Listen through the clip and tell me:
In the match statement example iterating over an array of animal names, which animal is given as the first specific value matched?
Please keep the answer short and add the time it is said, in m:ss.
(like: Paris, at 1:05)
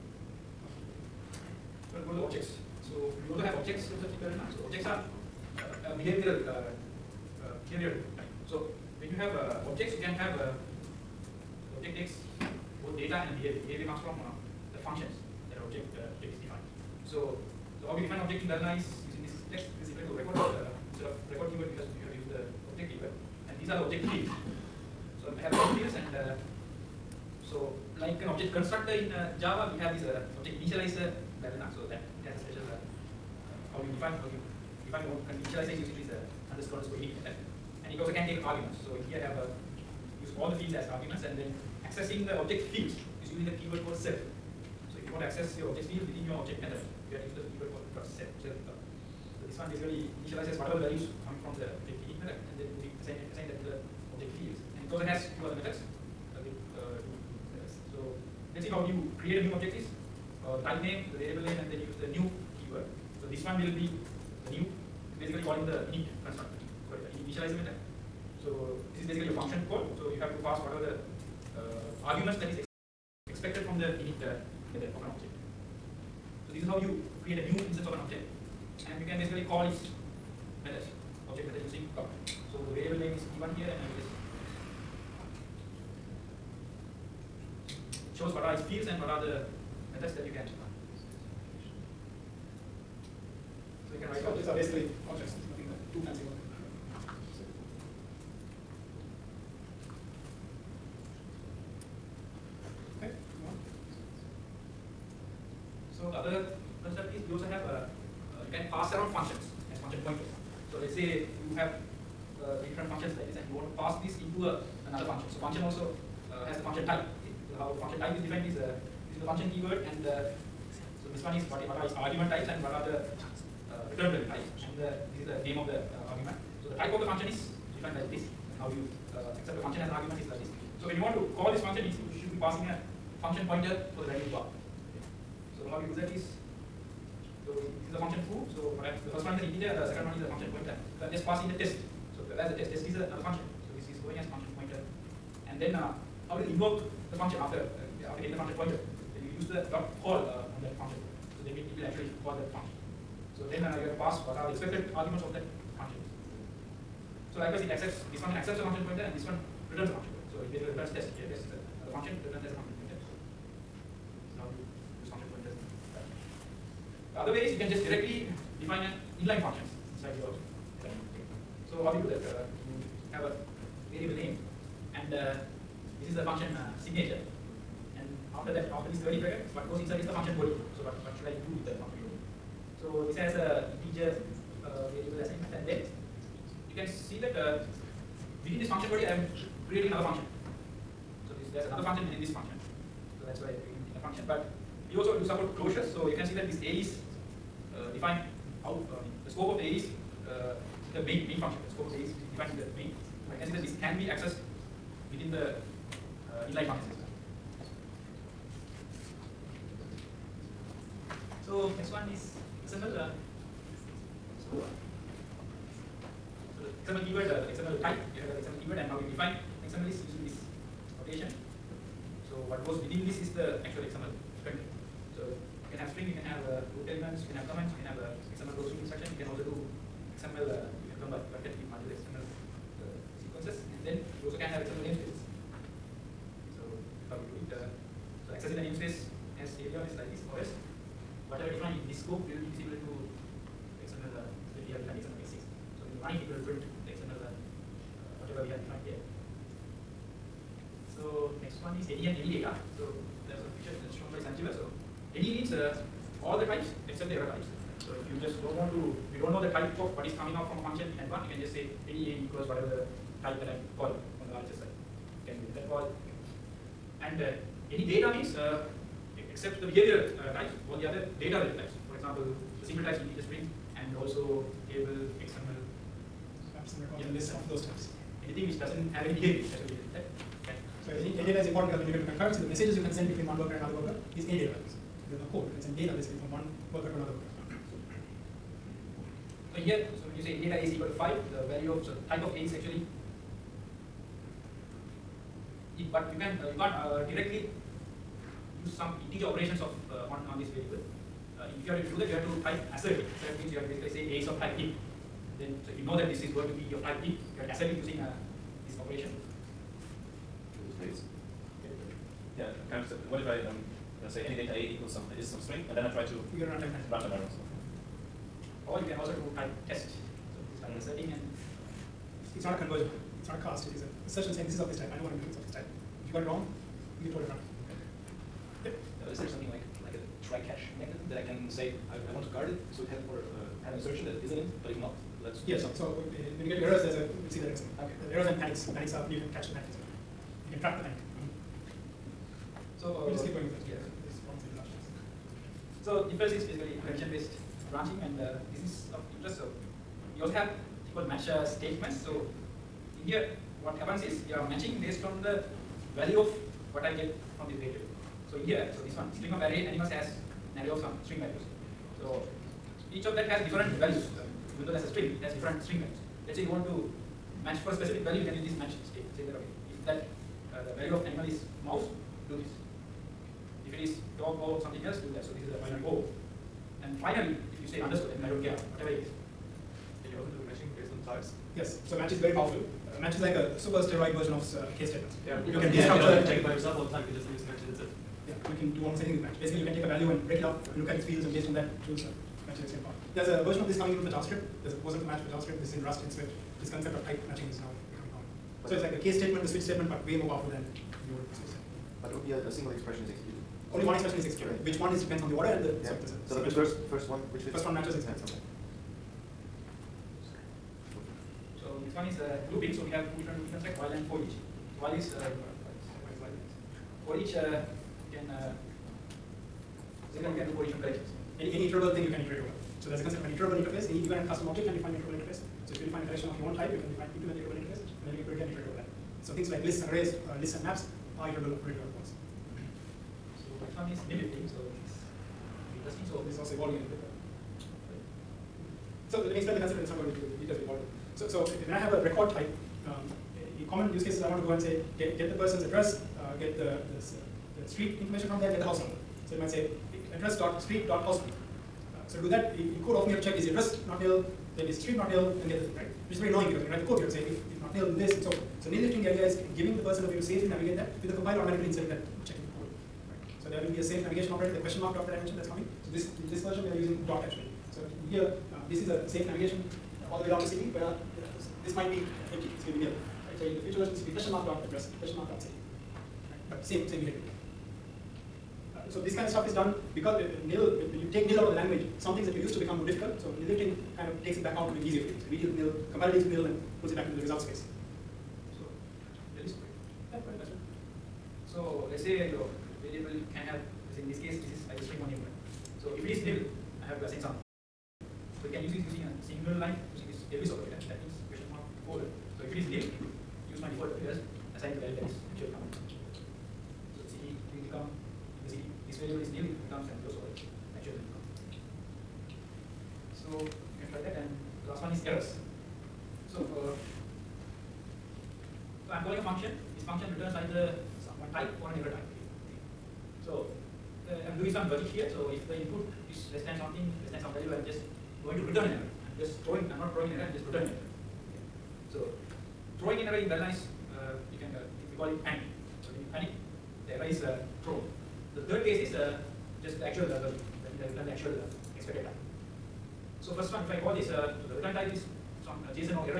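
mouse, at 6:11.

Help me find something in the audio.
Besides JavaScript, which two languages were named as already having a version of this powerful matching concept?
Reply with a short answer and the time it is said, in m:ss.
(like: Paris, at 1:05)
Rust and Swift, at 6:35.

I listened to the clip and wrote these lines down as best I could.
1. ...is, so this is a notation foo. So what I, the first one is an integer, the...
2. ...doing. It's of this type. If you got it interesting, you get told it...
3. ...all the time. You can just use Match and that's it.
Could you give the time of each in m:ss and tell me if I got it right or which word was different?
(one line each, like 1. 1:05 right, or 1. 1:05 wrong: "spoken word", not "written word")
1. 2:16 wrong: "function", not "notation"
2. 5:25 wrong: "wrong", not "interesting"
3. 6:26 right.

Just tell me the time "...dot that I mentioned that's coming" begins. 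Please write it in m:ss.
7:44.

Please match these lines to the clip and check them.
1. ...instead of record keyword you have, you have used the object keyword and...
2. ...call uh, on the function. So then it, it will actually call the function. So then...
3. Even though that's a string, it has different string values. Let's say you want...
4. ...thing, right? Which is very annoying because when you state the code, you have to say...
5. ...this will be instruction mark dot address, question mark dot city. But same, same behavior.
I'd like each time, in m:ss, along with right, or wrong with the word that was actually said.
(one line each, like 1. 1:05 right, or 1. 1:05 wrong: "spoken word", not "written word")
1. 0:20 right
2. 2:30 right
3. 6:04 right
4. 7:35 wrong: "write", not "state"
5. 7:53 wrong: "question", not "instruction".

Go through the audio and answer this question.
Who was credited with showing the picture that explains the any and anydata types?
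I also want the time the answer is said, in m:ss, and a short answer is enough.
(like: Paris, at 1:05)
Sanjiva, at 4:14.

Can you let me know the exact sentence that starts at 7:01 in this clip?
Any, any iterable thing you can iterate over.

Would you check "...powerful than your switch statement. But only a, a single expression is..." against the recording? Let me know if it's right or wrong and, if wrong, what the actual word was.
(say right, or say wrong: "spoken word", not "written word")
right.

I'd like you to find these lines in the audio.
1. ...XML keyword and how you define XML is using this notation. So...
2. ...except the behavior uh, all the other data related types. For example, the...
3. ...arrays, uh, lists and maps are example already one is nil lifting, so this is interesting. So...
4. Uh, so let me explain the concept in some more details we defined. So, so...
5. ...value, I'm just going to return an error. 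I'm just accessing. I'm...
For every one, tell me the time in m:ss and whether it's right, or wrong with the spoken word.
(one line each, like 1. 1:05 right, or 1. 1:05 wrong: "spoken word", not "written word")
1. 3:38 right
2. 4:29 right
3. 7:09 wrong: "iterable", not "example"
4. 7:19 wrong: "evolved", not "defined"
5. 8:47 wrong: "throwing", not "accessing".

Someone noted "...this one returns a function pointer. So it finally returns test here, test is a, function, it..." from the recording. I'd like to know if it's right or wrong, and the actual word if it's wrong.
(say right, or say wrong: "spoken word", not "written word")
wrong: "basically", not "finally".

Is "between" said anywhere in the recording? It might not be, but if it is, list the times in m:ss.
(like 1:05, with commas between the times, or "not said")
4:43.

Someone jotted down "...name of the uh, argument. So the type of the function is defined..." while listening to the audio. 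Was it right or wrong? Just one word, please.
right.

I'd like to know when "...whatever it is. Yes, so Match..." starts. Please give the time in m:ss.
6:18.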